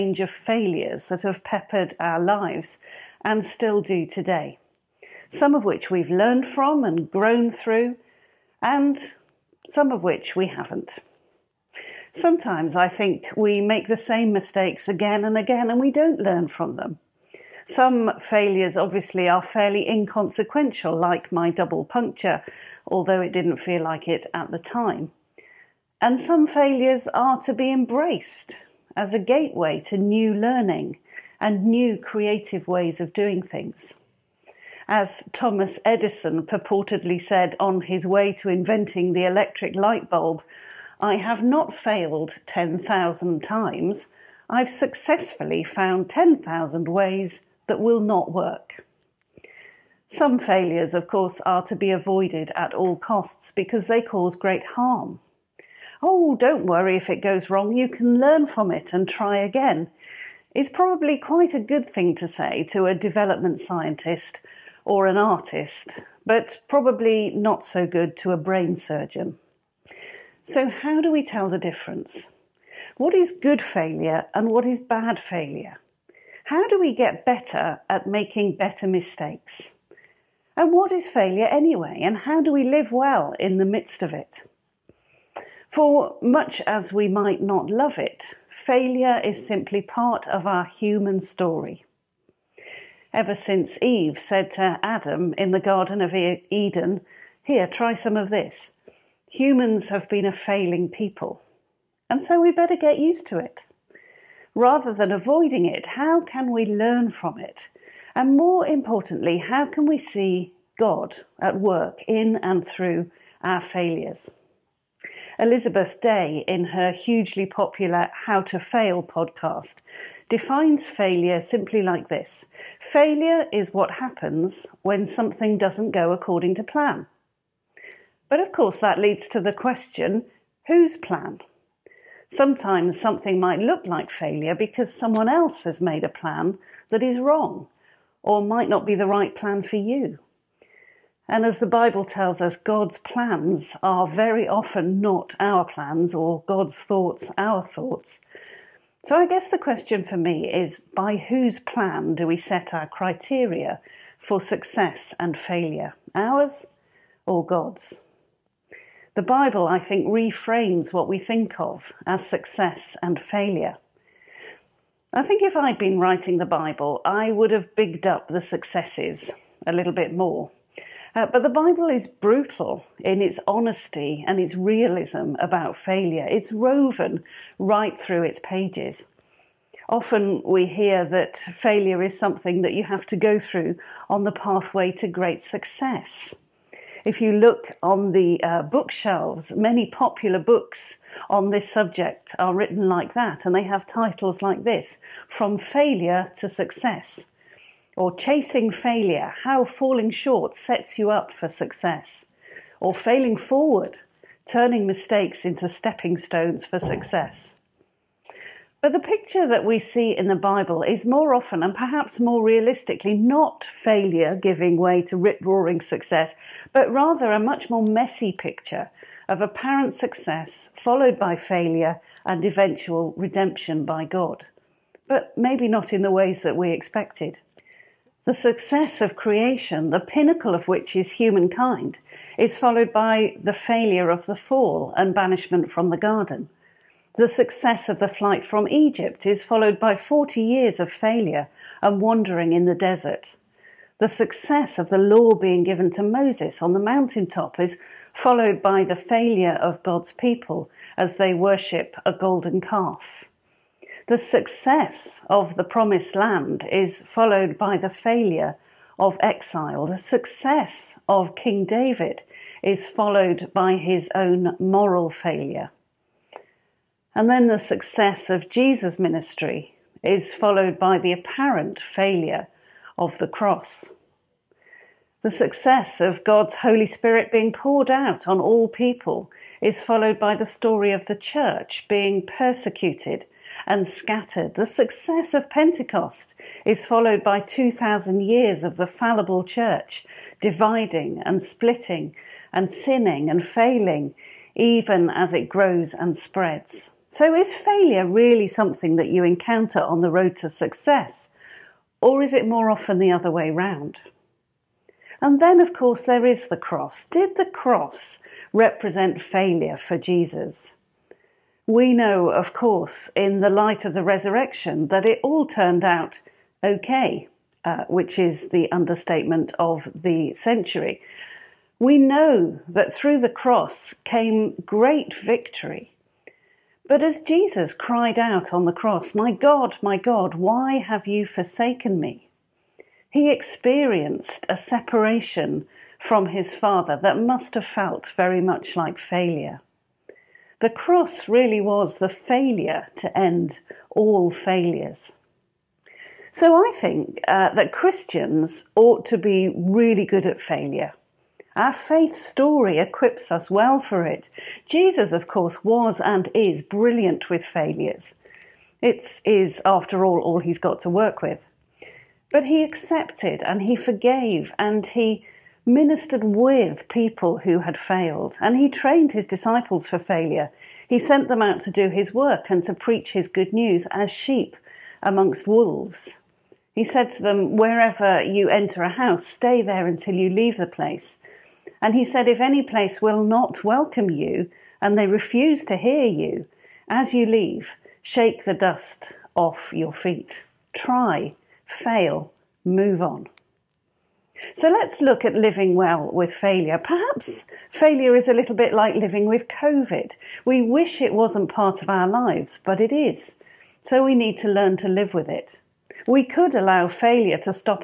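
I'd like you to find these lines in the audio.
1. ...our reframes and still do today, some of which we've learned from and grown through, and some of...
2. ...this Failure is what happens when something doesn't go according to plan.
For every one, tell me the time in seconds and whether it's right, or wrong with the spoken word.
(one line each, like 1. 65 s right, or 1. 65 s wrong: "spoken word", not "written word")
1. 2 s wrong: "lives", not "reframes"
2. 122 s right.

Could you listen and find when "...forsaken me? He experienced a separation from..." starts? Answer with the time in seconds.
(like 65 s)
331 s.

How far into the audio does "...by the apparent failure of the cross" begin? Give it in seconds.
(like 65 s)
270 s.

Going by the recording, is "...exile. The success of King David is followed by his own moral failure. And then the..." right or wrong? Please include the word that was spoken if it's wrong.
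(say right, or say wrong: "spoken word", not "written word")
right.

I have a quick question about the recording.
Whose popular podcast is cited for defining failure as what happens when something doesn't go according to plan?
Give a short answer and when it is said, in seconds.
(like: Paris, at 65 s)
Elizabeth Day, at 115 s.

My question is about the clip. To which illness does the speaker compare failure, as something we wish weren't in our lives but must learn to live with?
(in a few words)
COVID.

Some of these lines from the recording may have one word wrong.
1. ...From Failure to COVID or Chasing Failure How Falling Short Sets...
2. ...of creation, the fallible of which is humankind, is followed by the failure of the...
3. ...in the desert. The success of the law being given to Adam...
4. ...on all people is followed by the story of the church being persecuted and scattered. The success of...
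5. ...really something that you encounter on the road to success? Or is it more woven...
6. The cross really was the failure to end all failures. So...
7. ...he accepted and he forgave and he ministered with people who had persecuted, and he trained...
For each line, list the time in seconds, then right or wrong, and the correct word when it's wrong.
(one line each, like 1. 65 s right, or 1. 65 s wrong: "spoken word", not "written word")
1. 195 s wrong: "Success", not "COVID"
2. 229 s wrong: "pinnacle", not "fallible"
3. 242 s wrong: "Moses", not "Adam"
4. 278 s right
5. 298 s wrong: "often", not "woven"
6. 340 s right
7. 362 s wrong: "failed", not "persecuted".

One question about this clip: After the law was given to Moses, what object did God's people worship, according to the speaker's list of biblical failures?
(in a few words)
A golden calf.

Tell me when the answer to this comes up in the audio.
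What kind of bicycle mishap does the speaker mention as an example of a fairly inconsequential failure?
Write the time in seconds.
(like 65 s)
21 s.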